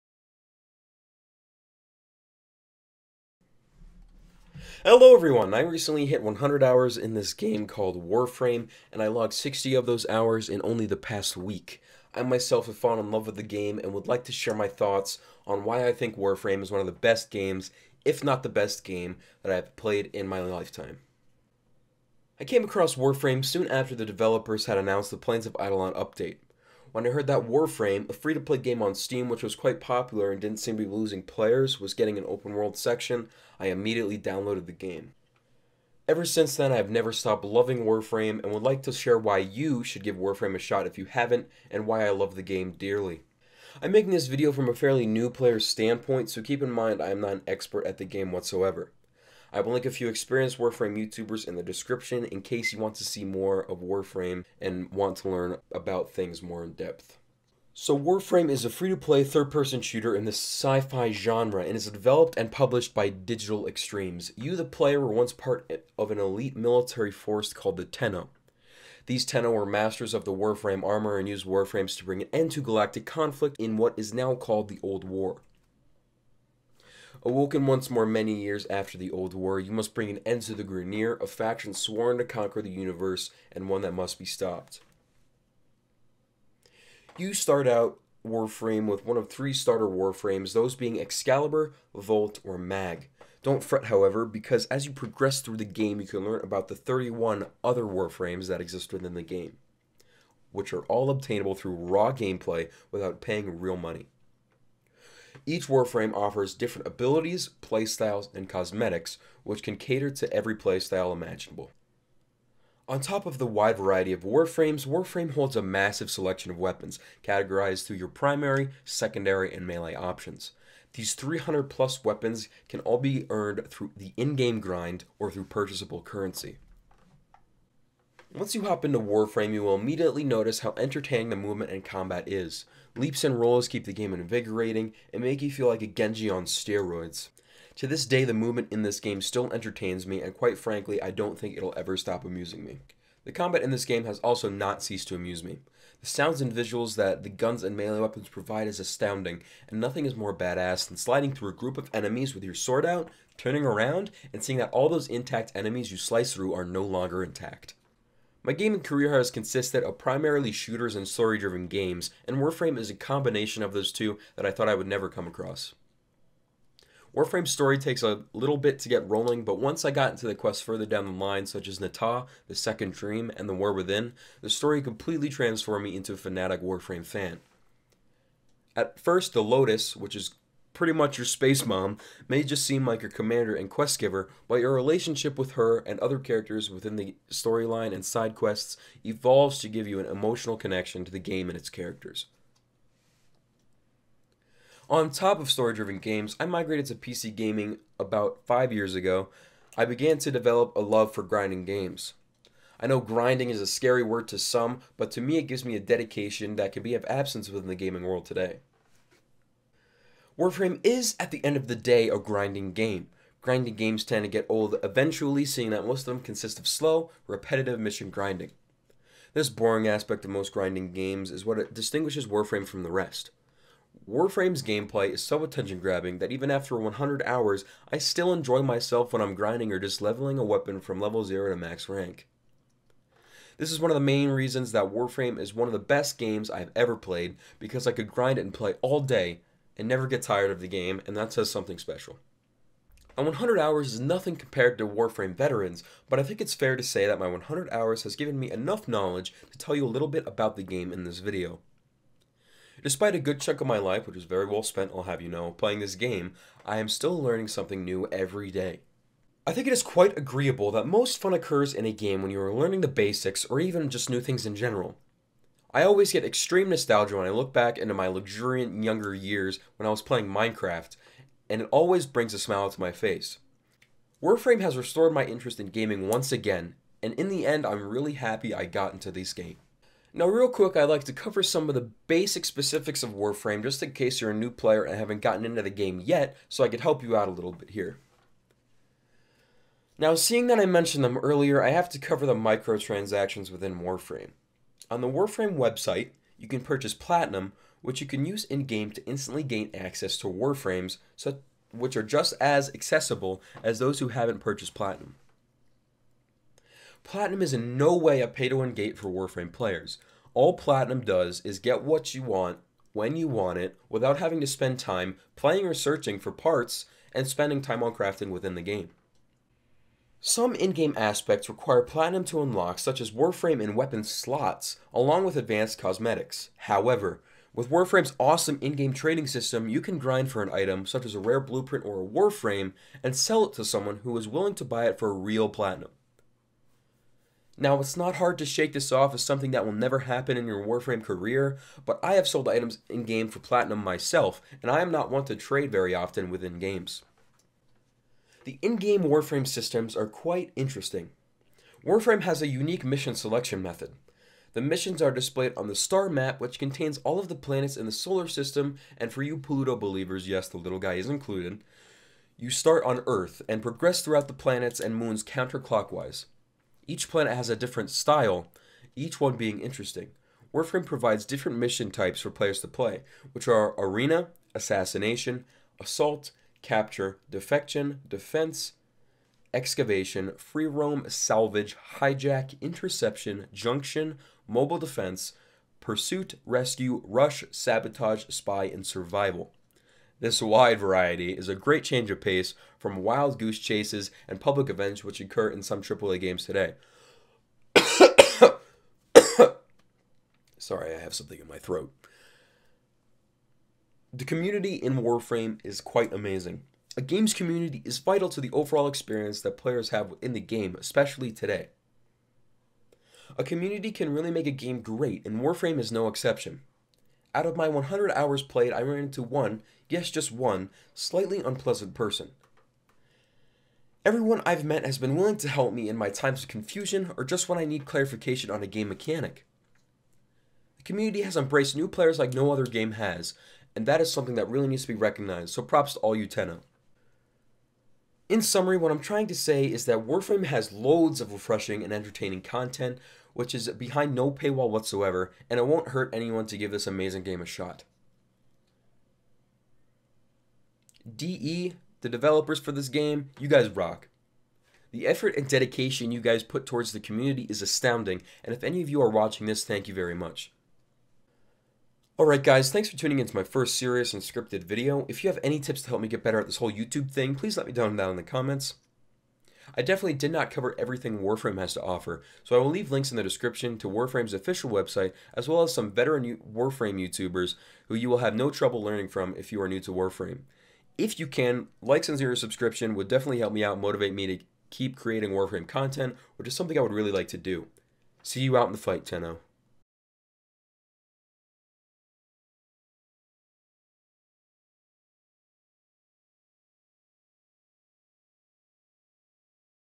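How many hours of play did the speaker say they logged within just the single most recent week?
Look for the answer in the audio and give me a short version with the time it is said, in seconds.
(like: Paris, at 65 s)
60, at 9 s.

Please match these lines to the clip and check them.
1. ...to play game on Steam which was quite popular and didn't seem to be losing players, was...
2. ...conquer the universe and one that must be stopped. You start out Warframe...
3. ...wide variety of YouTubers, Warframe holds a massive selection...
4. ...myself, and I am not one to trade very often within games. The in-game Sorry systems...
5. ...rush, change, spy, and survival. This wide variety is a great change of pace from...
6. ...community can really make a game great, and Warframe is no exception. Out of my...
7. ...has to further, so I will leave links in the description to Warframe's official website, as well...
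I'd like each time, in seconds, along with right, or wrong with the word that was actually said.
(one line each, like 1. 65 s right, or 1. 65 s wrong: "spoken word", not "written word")
1. 28 s right
2. 82 s right
3. 113 s wrong: "Warframes", not "YouTubers"
4. 343 s wrong: "Warframe", not "Sorry"
5. 387 s wrong: "sabotage", not "change"
6. 413 s right
7. 471 s wrong: "offer", not "further".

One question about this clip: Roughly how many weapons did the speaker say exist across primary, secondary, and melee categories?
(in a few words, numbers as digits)
300 plus.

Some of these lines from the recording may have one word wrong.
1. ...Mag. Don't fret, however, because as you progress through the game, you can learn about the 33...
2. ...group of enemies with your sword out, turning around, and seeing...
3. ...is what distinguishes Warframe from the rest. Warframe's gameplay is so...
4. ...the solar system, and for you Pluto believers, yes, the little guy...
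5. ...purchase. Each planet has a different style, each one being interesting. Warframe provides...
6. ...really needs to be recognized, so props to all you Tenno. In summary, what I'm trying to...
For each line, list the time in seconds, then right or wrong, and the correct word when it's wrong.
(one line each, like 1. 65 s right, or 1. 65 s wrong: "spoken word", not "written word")
1. 92 s wrong: "31", not "33"
2. 151 s right
3. 221 s right
4. 357 s right
5. 365 s wrong: "counterclockwise", not "purchase"
6. 434 s right.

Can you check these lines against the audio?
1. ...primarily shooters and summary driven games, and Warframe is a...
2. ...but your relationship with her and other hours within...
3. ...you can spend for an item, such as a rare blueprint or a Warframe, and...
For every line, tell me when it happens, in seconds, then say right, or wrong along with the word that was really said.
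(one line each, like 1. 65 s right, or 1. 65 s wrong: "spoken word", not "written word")
1. 159 s wrong: "story", not "summary"
2. 184 s wrong: "characters", not "hours"
3. 329 s wrong: "grind", not "spend".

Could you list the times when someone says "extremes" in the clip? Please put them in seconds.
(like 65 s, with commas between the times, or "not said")
63 s, 266 s.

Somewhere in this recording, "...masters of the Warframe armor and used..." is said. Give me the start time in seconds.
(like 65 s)
69 s.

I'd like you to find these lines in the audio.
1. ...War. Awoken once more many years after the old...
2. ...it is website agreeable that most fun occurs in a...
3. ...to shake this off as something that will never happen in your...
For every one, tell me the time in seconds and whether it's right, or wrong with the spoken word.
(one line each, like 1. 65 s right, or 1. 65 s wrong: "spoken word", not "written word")
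1. 75 s right
2. 259 s wrong: "quite", not "website"
3. 338 s right.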